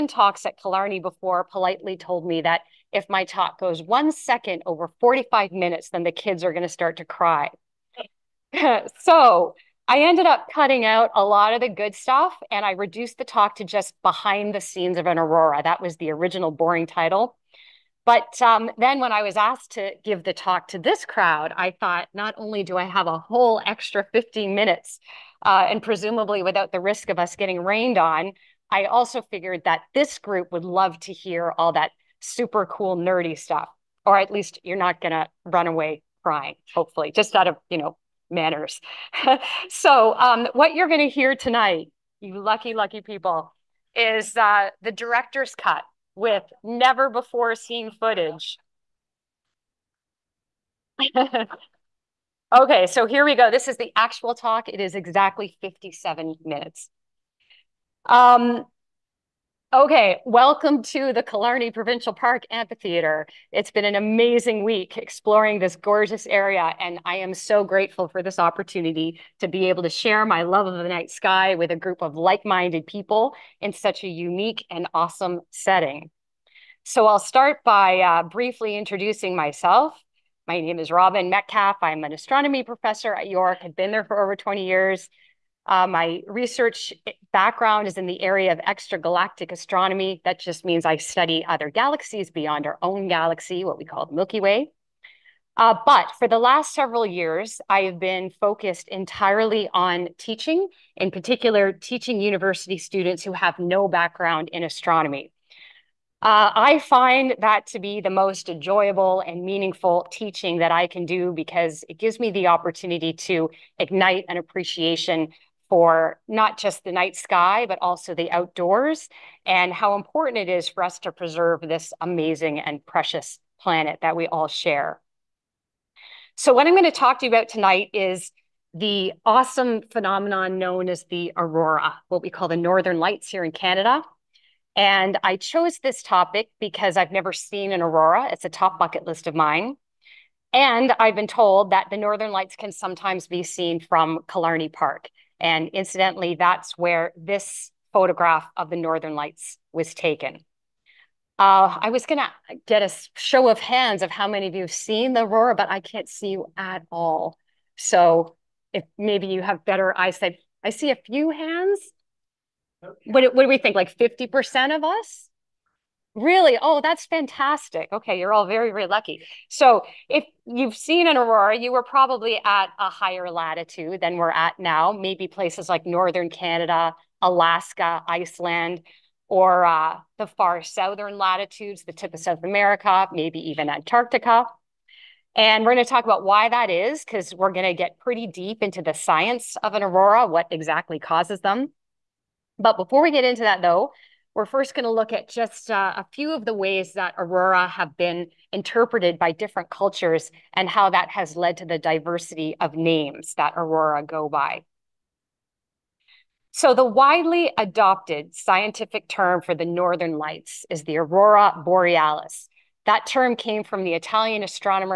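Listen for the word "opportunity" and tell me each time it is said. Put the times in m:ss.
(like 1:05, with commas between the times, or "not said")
1:08, 1:52.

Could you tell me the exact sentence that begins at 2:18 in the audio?
It's a top bucket list of mine.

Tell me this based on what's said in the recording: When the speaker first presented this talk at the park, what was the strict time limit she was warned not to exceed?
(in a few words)
45 minutes.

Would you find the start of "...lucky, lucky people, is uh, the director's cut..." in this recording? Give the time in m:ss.
0:42.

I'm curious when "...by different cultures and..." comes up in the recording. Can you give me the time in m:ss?
3:19.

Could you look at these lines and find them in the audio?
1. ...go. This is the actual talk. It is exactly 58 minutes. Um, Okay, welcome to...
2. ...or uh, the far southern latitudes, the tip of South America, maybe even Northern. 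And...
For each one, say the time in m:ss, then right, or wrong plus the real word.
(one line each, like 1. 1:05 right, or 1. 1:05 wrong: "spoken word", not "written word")
1. 0:53 wrong: "57", not "58"
2. 2:59 wrong: "Antarctica", not "Northern".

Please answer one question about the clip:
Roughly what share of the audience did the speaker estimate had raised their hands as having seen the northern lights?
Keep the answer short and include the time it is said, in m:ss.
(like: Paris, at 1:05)
50%, at 2:43.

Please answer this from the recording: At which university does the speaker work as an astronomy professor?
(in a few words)
York.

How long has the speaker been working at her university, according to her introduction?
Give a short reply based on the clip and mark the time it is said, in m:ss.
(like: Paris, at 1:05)
over 20 years, at 1:24.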